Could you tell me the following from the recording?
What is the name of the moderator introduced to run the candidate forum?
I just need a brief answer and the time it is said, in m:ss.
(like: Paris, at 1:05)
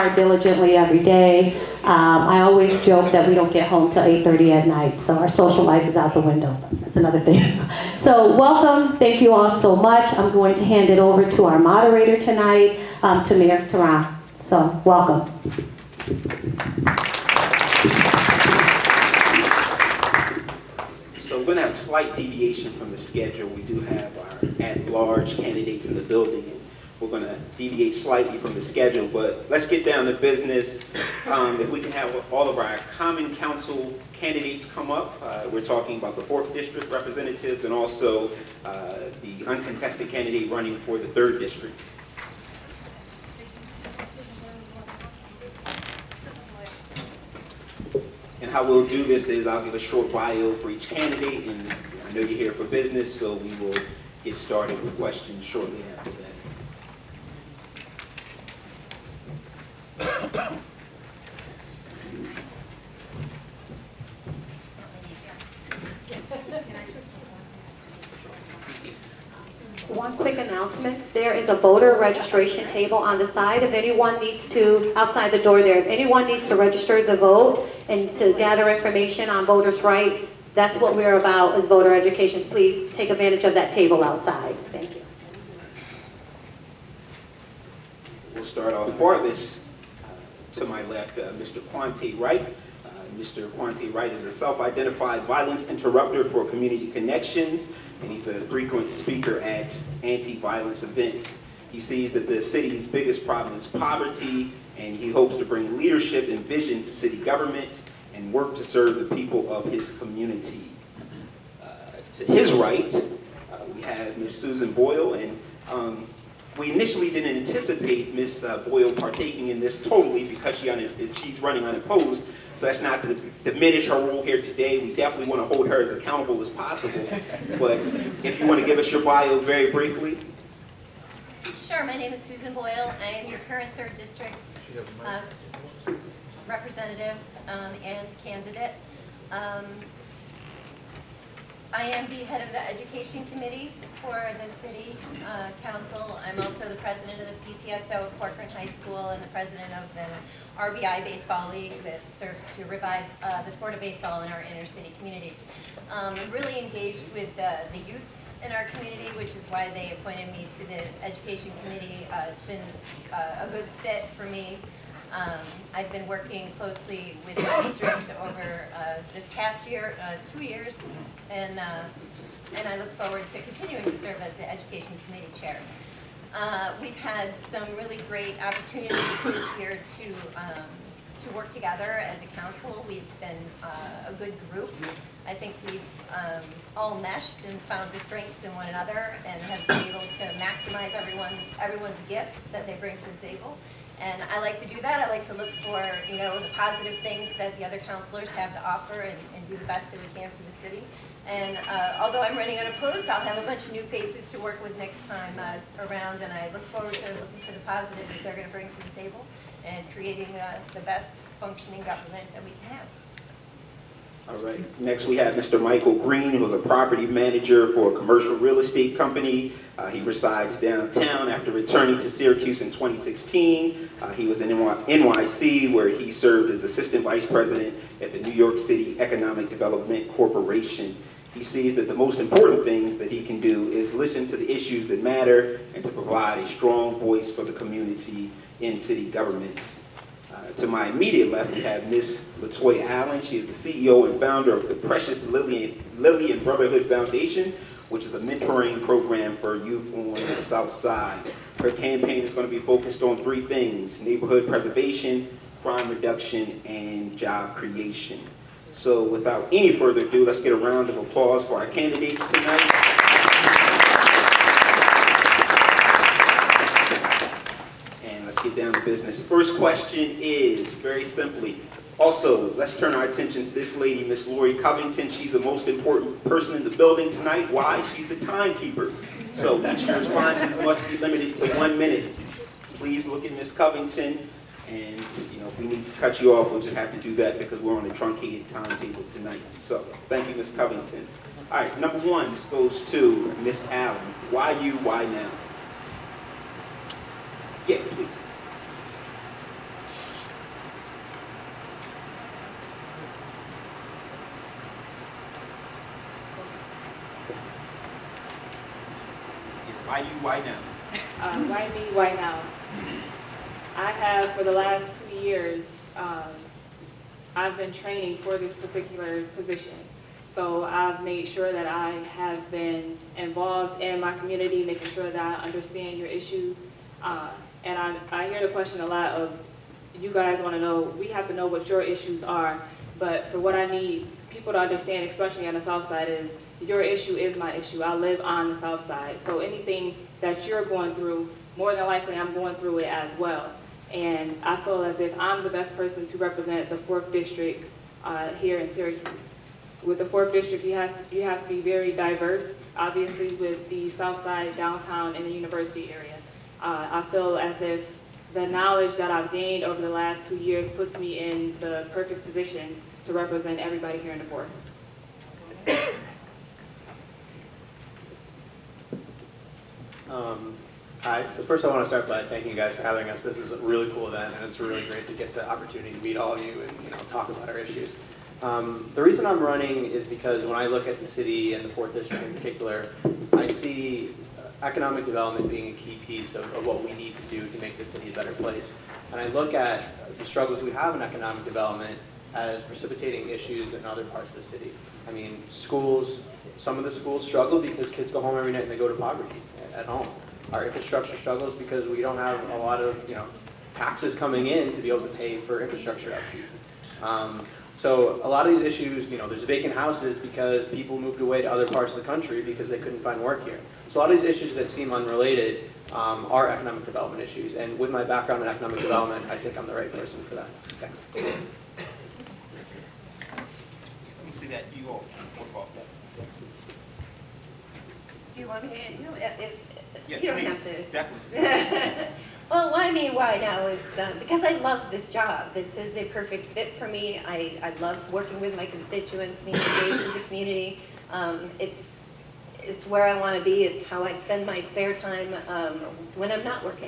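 Tamir Taran, at 0:13.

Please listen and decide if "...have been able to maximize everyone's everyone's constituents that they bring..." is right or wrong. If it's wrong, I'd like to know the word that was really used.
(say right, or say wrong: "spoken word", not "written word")
wrong: "gifts", not "constituents".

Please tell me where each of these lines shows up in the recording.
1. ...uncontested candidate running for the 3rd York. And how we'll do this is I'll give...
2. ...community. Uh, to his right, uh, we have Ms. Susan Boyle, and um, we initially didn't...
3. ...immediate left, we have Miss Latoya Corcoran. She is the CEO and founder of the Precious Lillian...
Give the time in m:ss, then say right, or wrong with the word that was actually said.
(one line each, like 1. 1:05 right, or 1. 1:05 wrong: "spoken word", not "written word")
1. 0:39 wrong: "District", not "York"
2. 1:49 right
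3. 4:00 wrong: "Allen", not "Corcoran".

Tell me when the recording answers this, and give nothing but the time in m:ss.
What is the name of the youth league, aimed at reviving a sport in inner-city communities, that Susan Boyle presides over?
2:30.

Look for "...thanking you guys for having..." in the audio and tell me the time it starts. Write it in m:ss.
6:12.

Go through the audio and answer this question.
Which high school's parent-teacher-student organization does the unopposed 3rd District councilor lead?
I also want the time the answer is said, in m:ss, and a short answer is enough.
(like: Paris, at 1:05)
Corcoran High School, at 2:28.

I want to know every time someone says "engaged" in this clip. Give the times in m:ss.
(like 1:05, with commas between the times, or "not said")
2:36, 7:19.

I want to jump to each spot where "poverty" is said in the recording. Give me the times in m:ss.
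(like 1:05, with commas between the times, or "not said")
1:43, 6:38.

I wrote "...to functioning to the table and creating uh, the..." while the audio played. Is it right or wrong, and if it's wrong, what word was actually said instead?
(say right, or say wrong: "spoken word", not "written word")
wrong: "bring", not "functioning".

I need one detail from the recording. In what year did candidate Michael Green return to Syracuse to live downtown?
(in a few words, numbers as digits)
2016.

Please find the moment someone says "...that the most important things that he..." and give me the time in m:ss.
3:51.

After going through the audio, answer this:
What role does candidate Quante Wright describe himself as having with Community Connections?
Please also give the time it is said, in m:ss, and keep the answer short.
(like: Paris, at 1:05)
violence interrupter, at 1:35.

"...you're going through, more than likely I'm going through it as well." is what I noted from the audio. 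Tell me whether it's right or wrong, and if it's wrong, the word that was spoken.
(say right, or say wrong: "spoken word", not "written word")
right.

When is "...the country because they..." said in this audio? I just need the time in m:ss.
6:52.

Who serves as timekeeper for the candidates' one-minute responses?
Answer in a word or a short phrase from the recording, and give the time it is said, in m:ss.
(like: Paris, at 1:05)
Lori Covington, at 4:34.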